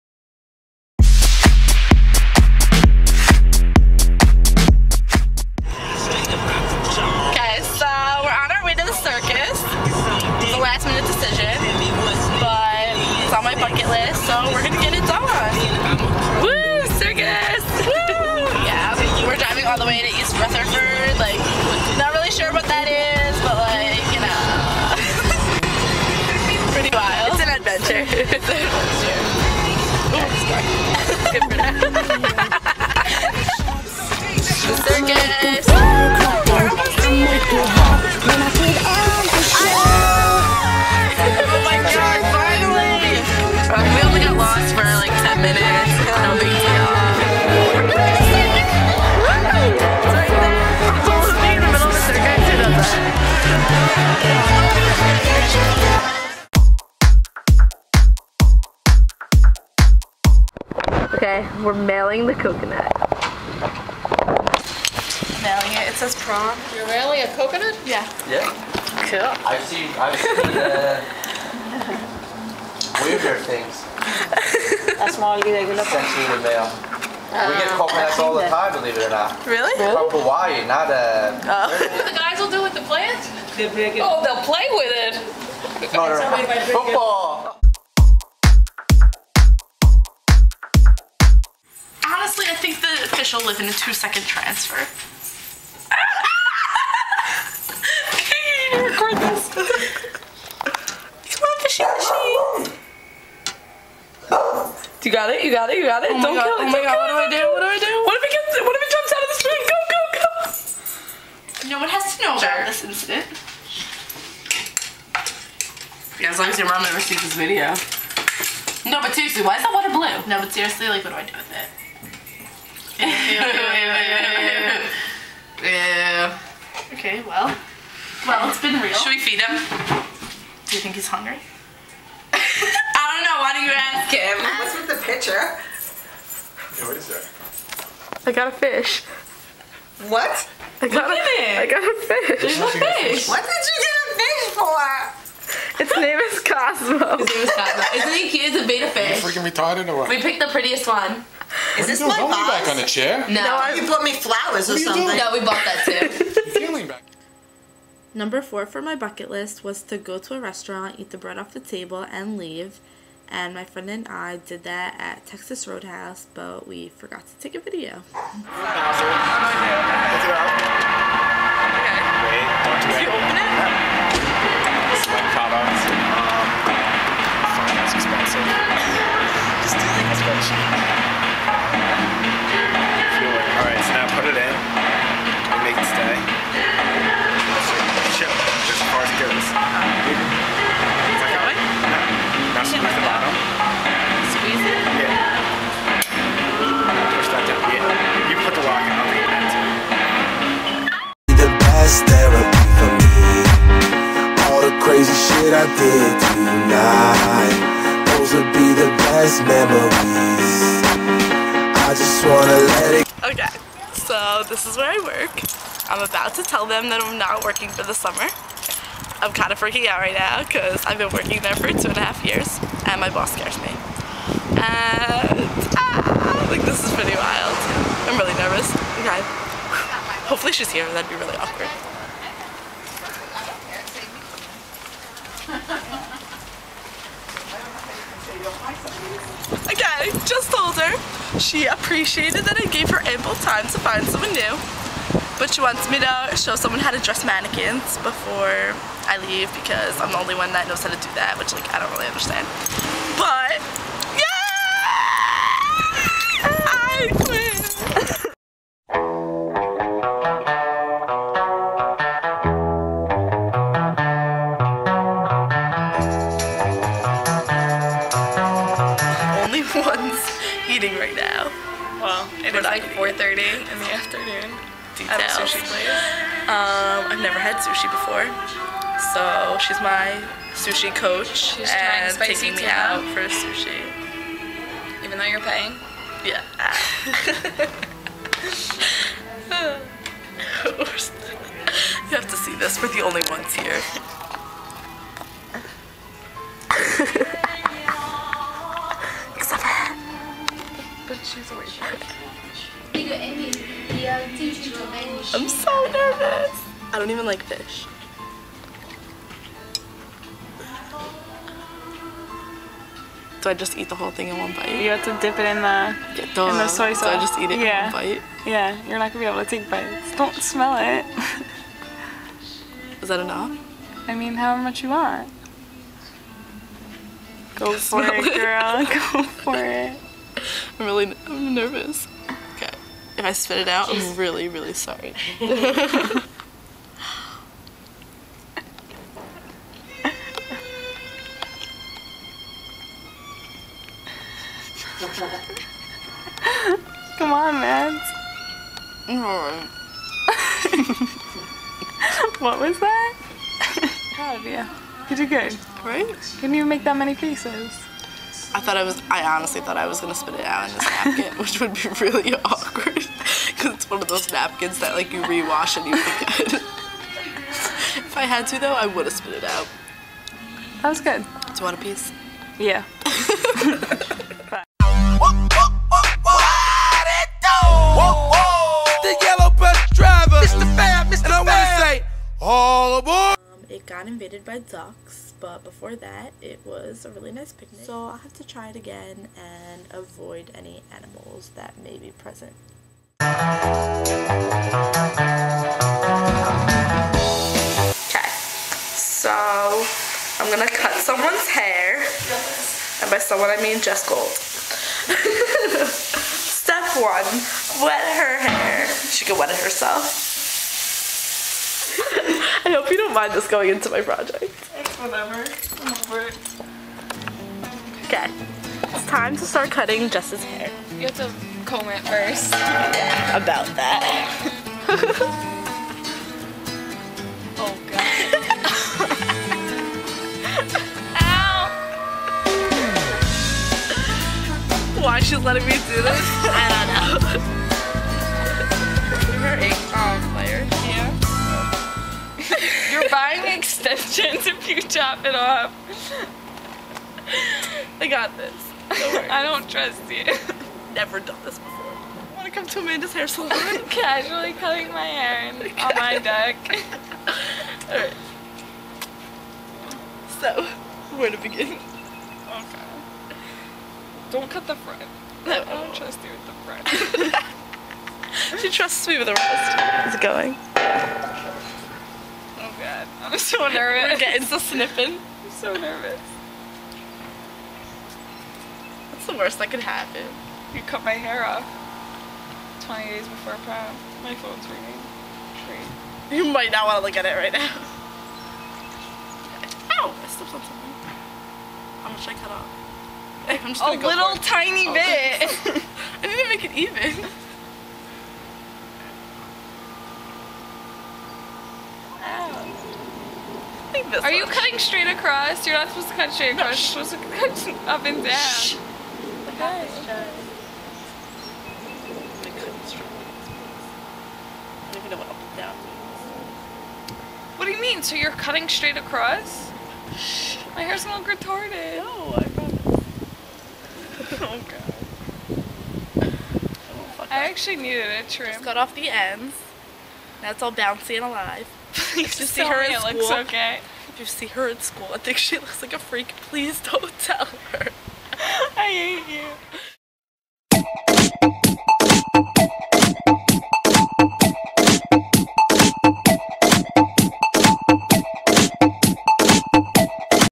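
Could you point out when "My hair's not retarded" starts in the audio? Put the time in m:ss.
8:40.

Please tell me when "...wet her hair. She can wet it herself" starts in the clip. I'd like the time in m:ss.
6:47.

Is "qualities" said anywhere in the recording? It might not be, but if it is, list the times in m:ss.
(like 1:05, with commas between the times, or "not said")
not said.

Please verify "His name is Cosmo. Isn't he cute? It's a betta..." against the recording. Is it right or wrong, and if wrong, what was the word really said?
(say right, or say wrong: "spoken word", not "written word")
right.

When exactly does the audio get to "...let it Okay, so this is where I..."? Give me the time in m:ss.
3:32.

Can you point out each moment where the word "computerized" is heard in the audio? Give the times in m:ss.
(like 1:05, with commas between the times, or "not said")
not said.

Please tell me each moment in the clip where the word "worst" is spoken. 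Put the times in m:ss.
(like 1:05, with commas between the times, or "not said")
7:59.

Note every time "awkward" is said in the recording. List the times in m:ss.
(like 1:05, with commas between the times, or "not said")
3:51, 6:02.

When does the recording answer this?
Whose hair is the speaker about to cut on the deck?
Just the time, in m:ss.
6:43.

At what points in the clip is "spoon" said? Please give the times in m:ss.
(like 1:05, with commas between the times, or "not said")
1:49.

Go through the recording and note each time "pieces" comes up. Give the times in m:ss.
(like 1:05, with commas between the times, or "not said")
5:57, 6:11.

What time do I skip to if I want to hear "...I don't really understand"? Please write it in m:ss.
4:11.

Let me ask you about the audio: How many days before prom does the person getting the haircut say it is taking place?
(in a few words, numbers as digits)
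20.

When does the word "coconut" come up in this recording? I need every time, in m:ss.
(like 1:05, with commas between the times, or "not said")
1:02, 1:07, 1:17.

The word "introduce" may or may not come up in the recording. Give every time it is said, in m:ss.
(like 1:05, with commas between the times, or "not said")
not said.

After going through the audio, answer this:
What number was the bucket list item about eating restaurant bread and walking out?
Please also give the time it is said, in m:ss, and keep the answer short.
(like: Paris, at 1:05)
4, at 2:38.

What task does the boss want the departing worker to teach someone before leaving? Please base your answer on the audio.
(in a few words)
dress mannequins.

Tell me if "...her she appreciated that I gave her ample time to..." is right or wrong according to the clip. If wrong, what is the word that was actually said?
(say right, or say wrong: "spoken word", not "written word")
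right.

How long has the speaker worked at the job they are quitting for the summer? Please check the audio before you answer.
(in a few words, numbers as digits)
2 and a half years.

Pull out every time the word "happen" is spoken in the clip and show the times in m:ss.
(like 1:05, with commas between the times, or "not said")
7:59.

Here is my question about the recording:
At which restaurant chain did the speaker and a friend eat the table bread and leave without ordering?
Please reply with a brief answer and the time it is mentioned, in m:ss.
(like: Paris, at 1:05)
Texas Roadhouse, at 2:45.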